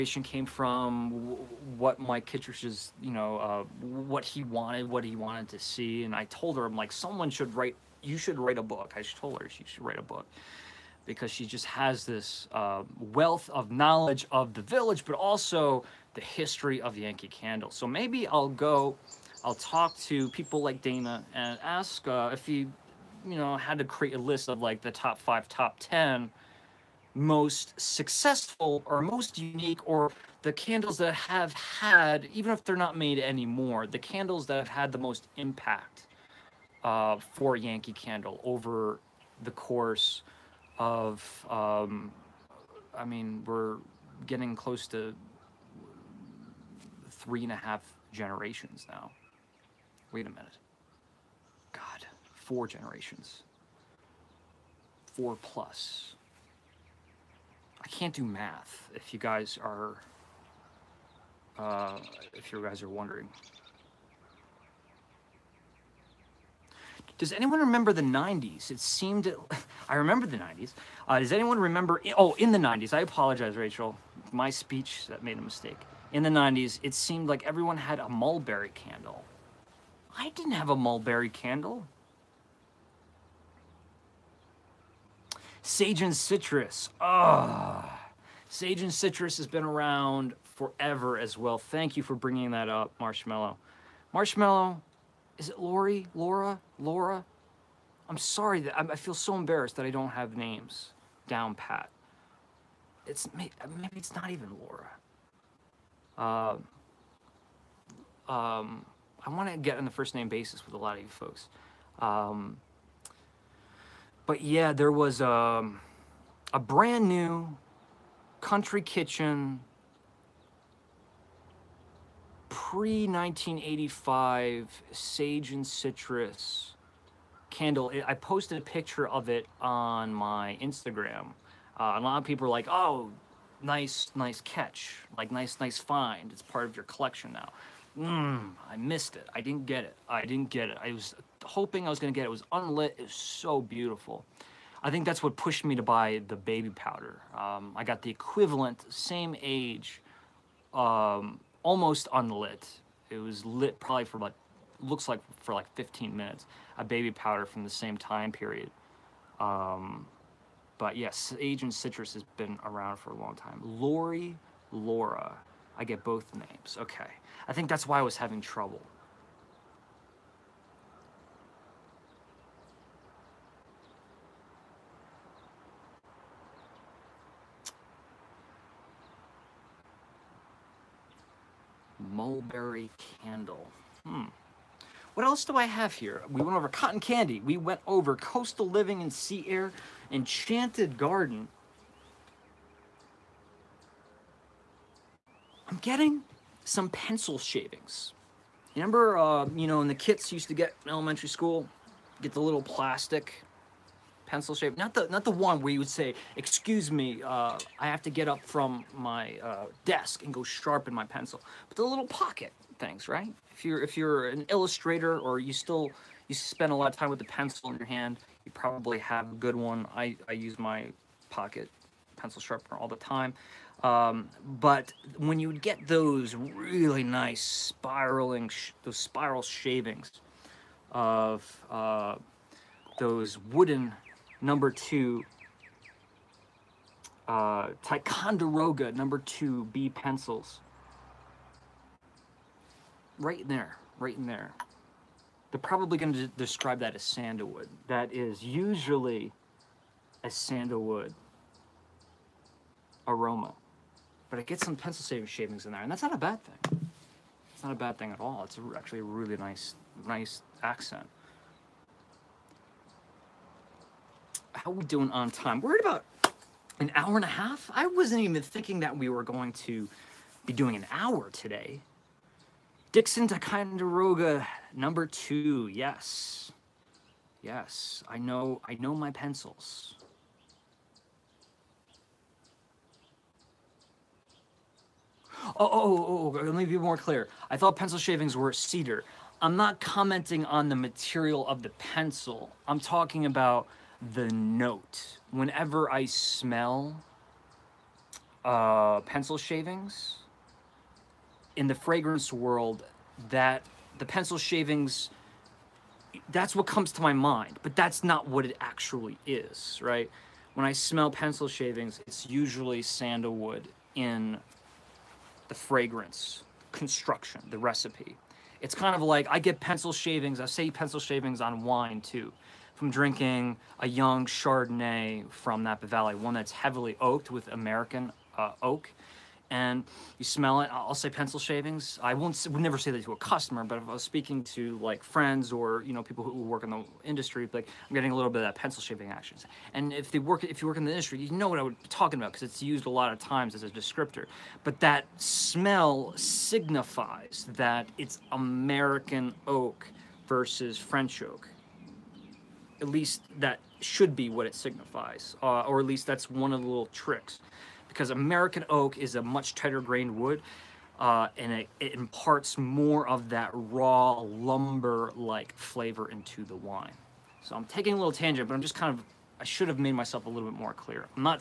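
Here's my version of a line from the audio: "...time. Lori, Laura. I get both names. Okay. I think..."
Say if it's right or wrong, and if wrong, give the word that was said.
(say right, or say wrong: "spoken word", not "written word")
right.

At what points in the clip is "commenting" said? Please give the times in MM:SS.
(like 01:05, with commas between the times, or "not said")
04:49.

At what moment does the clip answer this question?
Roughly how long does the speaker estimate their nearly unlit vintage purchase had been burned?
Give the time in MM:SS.
02:35.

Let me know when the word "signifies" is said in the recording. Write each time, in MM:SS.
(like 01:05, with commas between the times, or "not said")
05:46, 05:54.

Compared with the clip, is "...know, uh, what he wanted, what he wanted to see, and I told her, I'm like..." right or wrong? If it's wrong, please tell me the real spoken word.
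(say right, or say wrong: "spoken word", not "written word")
right.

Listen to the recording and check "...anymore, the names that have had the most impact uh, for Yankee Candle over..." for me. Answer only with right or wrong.
wrong.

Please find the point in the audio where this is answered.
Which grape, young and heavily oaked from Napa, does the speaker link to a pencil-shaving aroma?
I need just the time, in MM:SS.
05:24.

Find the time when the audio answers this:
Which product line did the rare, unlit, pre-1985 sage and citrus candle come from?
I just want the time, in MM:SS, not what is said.
01:58.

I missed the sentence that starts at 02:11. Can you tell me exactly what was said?
Uh, a lot of people are like, oh, nice, nice catch.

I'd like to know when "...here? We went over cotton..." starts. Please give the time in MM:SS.
03:05.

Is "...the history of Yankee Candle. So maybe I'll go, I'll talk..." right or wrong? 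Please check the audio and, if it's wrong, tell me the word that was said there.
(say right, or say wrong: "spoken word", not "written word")
right.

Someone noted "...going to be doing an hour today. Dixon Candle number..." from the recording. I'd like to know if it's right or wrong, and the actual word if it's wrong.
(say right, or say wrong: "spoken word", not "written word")
wrong: "Ticonderoga", not "Candle".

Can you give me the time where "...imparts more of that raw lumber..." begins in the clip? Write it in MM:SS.
06:01.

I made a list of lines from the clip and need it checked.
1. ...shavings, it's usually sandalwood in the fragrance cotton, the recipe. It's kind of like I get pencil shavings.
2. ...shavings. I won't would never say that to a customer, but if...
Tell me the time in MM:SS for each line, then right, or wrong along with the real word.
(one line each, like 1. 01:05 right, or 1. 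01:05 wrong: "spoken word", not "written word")
1. 05:11 wrong: "construction", not "cotton"
2. 05:31 right.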